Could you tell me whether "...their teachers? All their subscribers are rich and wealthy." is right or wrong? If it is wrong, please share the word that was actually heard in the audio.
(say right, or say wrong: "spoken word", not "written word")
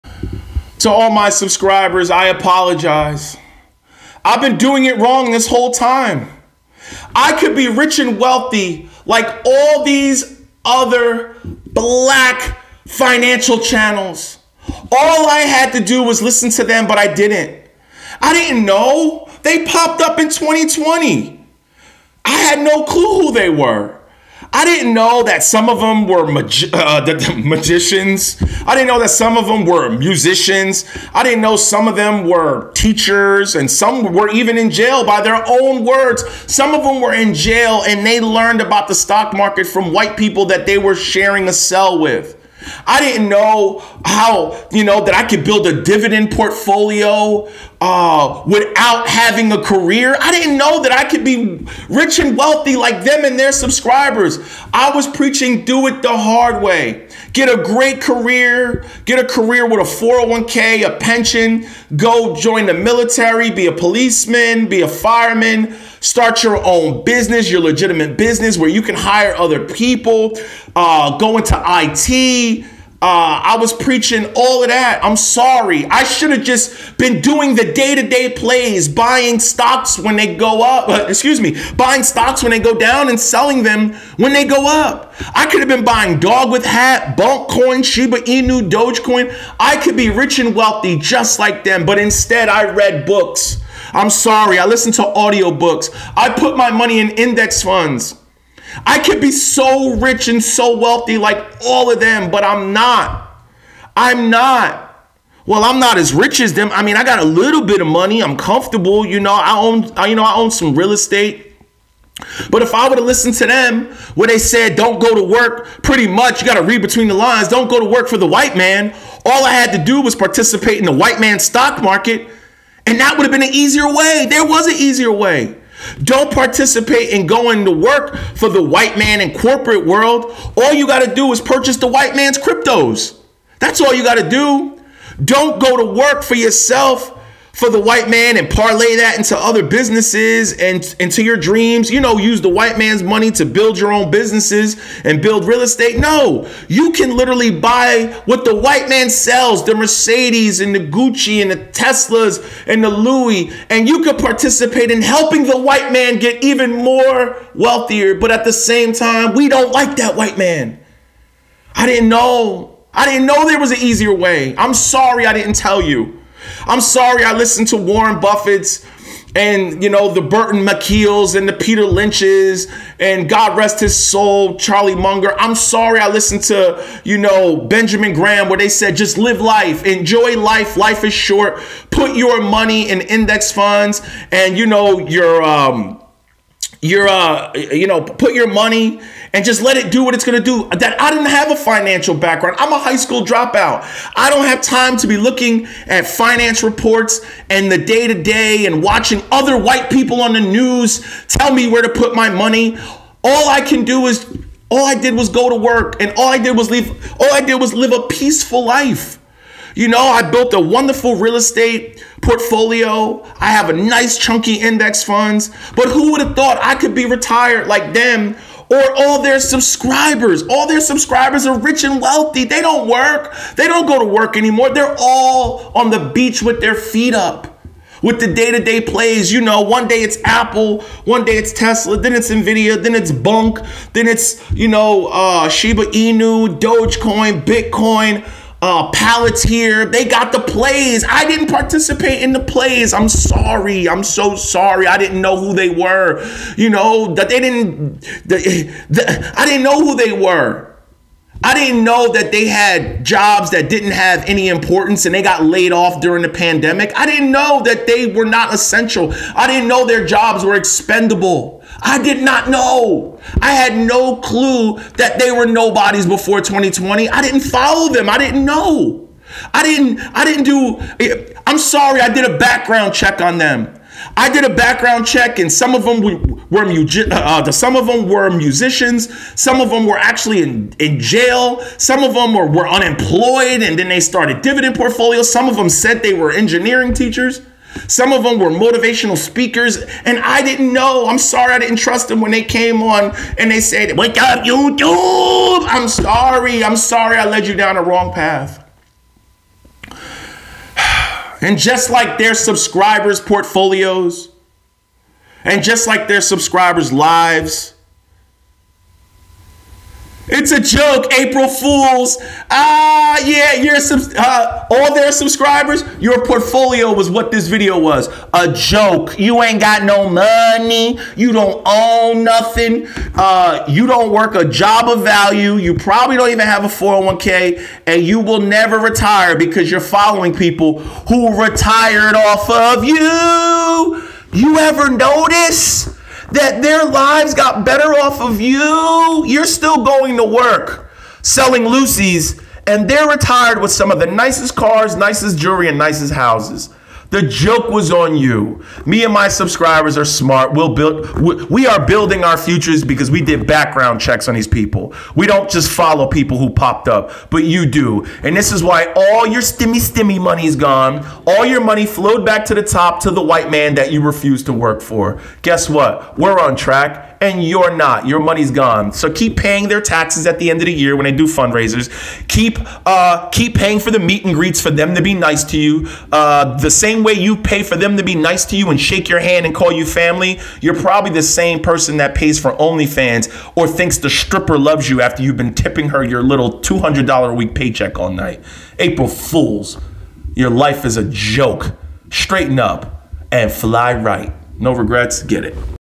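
wrong: "subscribers", not "teachers".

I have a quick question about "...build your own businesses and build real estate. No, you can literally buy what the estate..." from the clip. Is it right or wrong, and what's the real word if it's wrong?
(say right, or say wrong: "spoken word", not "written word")
wrong: "white", not "estate".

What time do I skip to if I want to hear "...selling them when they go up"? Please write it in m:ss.
1:23.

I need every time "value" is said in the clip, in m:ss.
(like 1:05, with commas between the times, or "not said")
5:25.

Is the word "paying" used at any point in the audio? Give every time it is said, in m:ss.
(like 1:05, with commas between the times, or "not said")
6:09, 6:13.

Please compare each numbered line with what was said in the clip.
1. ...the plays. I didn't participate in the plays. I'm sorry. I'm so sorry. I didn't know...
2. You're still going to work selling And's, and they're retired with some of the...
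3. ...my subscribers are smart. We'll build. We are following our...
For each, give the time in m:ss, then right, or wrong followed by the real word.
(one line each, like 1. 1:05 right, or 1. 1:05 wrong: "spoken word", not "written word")
1. 4:00 right
2. 5:39 wrong: "Lucy", not "And"
3. 5:49 wrong: "building", not "following".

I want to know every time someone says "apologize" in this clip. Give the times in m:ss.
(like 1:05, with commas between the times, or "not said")
0:02.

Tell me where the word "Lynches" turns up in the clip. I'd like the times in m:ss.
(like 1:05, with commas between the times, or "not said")
2:51.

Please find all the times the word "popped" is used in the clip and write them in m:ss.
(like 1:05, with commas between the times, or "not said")
0:19, 5:56.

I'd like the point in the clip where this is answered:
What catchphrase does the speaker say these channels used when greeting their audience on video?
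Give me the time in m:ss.
4:53.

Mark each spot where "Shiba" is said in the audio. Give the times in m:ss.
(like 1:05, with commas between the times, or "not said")
1:27, 3:55.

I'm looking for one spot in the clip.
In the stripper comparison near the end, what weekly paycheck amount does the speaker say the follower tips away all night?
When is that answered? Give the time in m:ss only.
6:26.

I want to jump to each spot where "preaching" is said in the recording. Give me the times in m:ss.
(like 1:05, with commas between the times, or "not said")
0:55, 1:13.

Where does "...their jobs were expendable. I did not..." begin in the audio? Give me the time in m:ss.
4:19.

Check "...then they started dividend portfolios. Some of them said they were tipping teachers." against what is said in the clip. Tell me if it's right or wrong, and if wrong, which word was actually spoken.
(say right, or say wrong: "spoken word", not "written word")
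wrong: "engineering", not "tipping".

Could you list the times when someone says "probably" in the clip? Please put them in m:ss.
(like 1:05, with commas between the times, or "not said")
5:25, 6:20.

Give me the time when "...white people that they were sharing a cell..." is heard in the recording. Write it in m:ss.
0:39.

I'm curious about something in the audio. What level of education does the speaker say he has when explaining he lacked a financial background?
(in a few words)
high school dropout.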